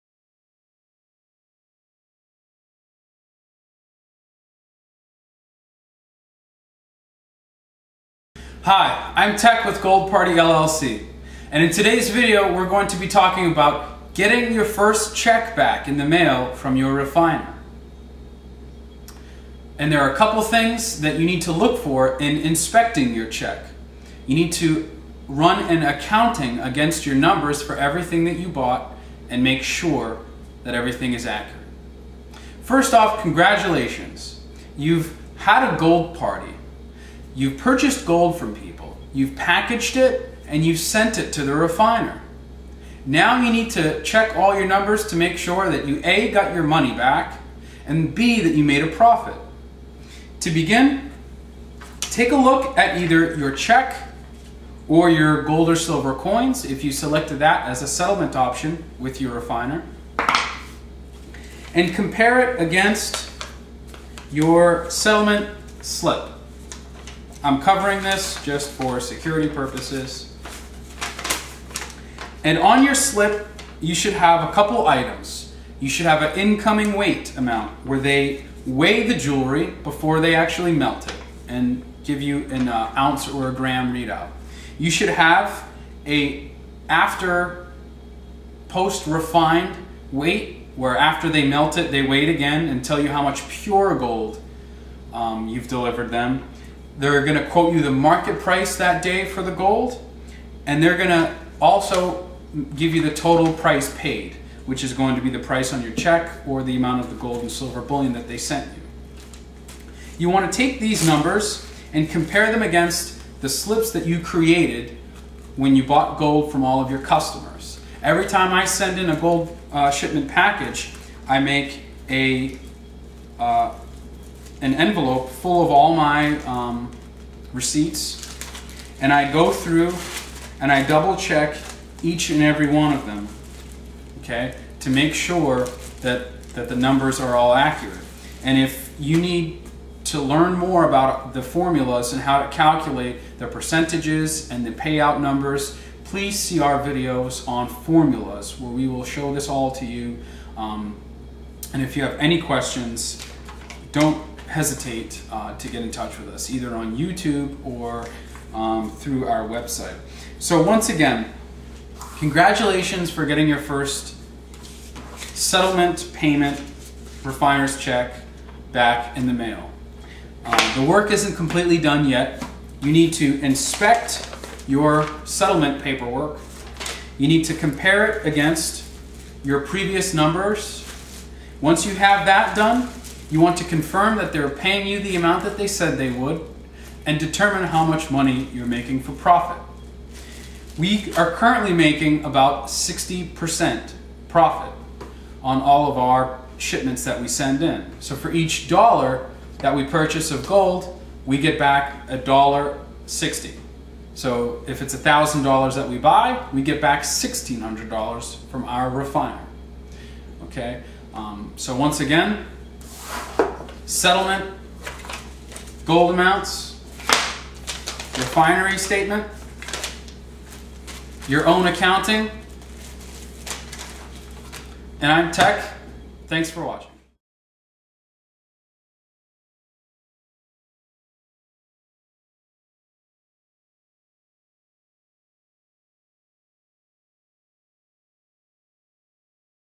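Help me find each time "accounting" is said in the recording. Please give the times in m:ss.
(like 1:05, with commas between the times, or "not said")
0:25, 3:41.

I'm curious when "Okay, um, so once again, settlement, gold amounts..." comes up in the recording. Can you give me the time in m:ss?
3:30.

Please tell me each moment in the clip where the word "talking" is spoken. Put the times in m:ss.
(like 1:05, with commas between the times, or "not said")
0:13.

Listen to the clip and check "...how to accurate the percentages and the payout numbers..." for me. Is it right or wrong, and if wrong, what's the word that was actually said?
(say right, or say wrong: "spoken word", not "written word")
wrong: "calculate", not "accurate".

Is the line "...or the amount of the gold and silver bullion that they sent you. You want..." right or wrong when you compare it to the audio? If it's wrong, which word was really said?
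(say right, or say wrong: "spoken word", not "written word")
right.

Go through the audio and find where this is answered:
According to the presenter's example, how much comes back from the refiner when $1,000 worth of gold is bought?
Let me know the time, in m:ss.
3:27.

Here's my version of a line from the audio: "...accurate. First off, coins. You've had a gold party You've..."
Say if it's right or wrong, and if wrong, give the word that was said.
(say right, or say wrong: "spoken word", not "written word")
wrong: "congratulations", not "coins".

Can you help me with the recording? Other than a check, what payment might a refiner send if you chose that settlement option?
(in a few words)
gold or silver coins.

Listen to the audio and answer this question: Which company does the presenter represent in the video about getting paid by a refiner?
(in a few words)
Gold Party LLC.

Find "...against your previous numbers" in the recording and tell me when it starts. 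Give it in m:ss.
2:58.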